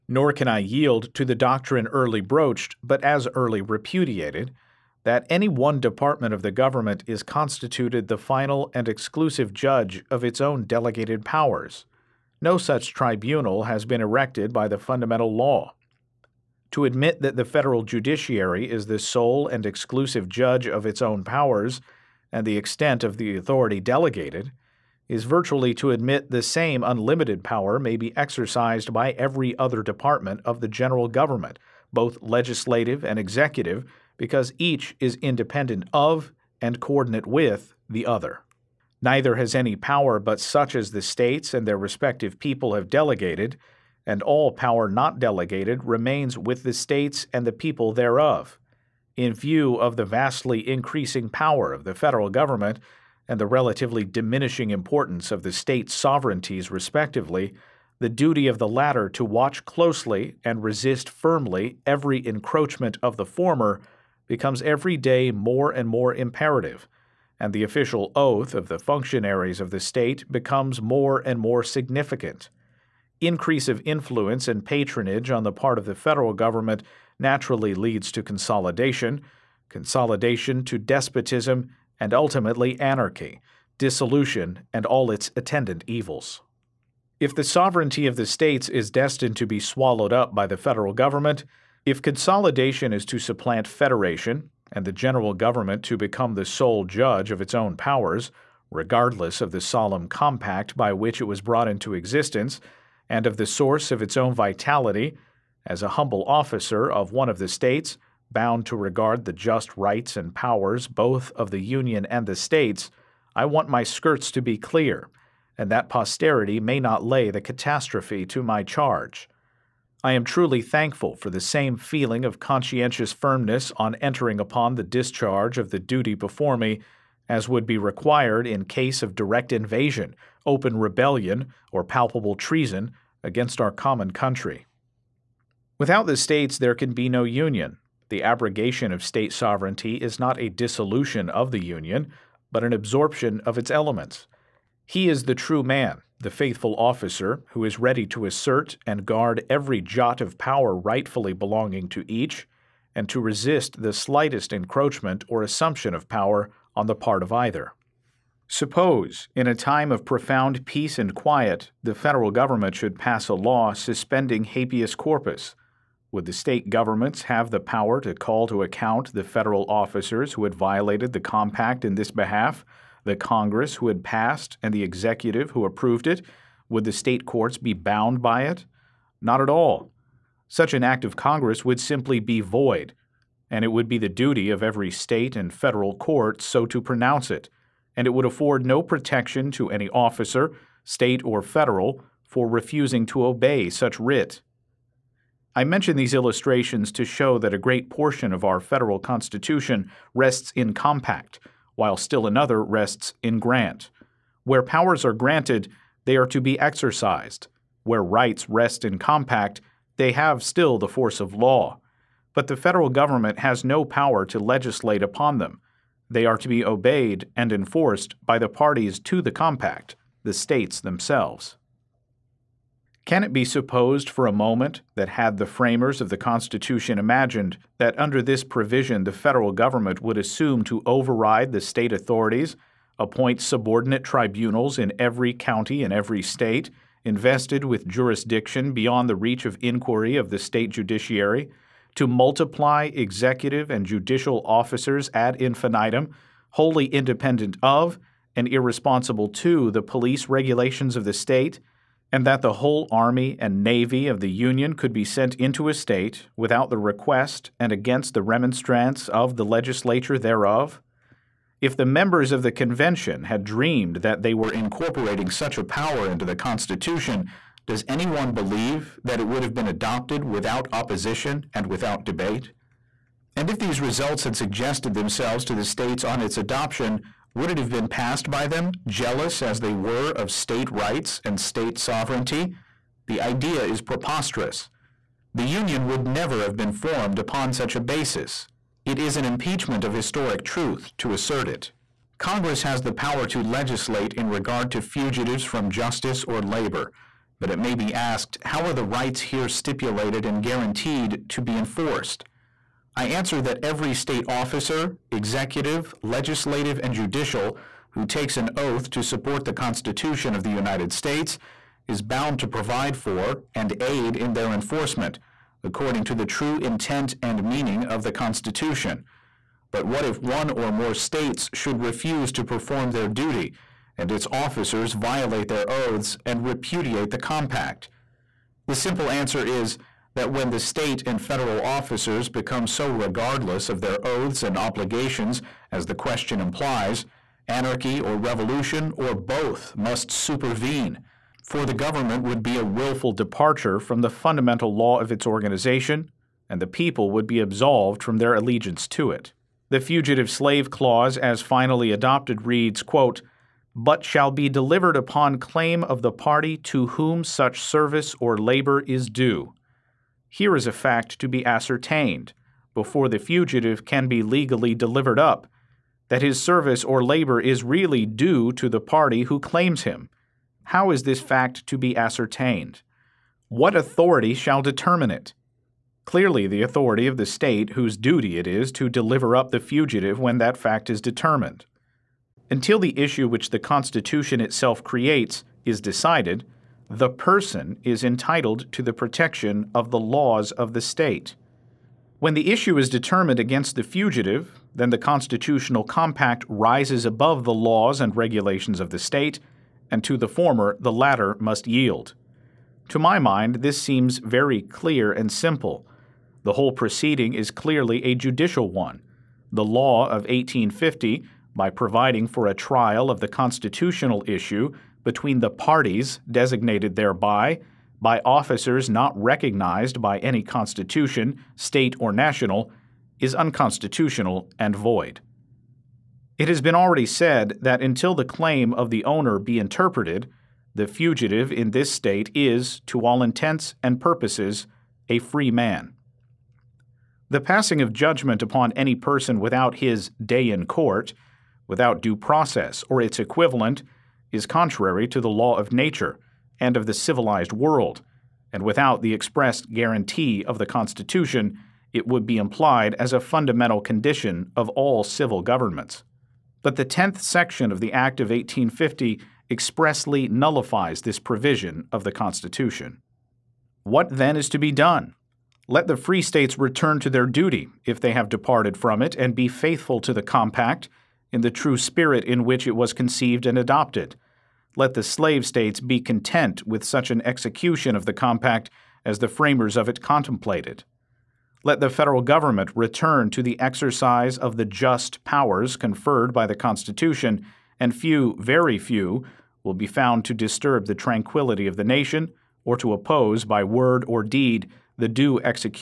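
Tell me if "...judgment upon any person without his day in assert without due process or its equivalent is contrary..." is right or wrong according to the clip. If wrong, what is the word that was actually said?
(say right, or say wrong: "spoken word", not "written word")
wrong: "court", not "assert".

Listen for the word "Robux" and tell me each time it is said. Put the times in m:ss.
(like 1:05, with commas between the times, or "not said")
not said.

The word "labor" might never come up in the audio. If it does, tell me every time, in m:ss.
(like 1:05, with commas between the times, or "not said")
4:56, 5:58, 6:07.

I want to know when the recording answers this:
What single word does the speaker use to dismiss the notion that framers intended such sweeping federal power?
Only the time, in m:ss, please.
4:43.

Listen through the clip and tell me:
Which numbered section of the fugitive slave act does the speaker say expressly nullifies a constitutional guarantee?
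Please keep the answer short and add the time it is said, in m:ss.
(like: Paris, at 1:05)
10th section, at 7:36.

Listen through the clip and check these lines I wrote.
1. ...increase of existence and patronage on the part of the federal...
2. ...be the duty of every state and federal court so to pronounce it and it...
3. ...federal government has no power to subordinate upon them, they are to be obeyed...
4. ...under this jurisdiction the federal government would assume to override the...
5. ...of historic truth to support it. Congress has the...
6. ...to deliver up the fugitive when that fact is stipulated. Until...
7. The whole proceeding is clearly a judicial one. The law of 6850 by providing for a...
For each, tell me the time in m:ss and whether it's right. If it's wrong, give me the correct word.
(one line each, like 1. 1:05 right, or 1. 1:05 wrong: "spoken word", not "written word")
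1. 1:13 wrong: "influence", not "existence"
2. 3:03 right
3. 3:32 wrong: "legislate", not "subordinate"
4. 3:47 wrong: "provision", not "jurisdiction"
5. 4:49 wrong: "assert", not "support"
6. 6:18 wrong: "determined", not "stipulated"
7. 6:46 wrong: "1850", not "6850".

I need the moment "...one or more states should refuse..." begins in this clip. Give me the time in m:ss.
5:20.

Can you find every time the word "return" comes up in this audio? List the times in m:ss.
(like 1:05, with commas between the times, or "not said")
7:46, 8:02.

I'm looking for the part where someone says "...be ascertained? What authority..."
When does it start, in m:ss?
6:11.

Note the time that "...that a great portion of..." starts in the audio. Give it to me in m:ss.
3:17.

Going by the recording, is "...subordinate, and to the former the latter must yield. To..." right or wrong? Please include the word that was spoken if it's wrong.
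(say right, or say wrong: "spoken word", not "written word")
wrong: "state", not "subordinate".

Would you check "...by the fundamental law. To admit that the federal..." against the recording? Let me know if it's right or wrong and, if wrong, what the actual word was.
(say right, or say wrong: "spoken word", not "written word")
right.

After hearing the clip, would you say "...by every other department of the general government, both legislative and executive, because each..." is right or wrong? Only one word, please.
right.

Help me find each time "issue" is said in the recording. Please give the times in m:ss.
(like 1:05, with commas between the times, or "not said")
6:22, 6:32, 6:54.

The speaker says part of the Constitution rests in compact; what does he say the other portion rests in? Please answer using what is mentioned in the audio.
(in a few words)
grant.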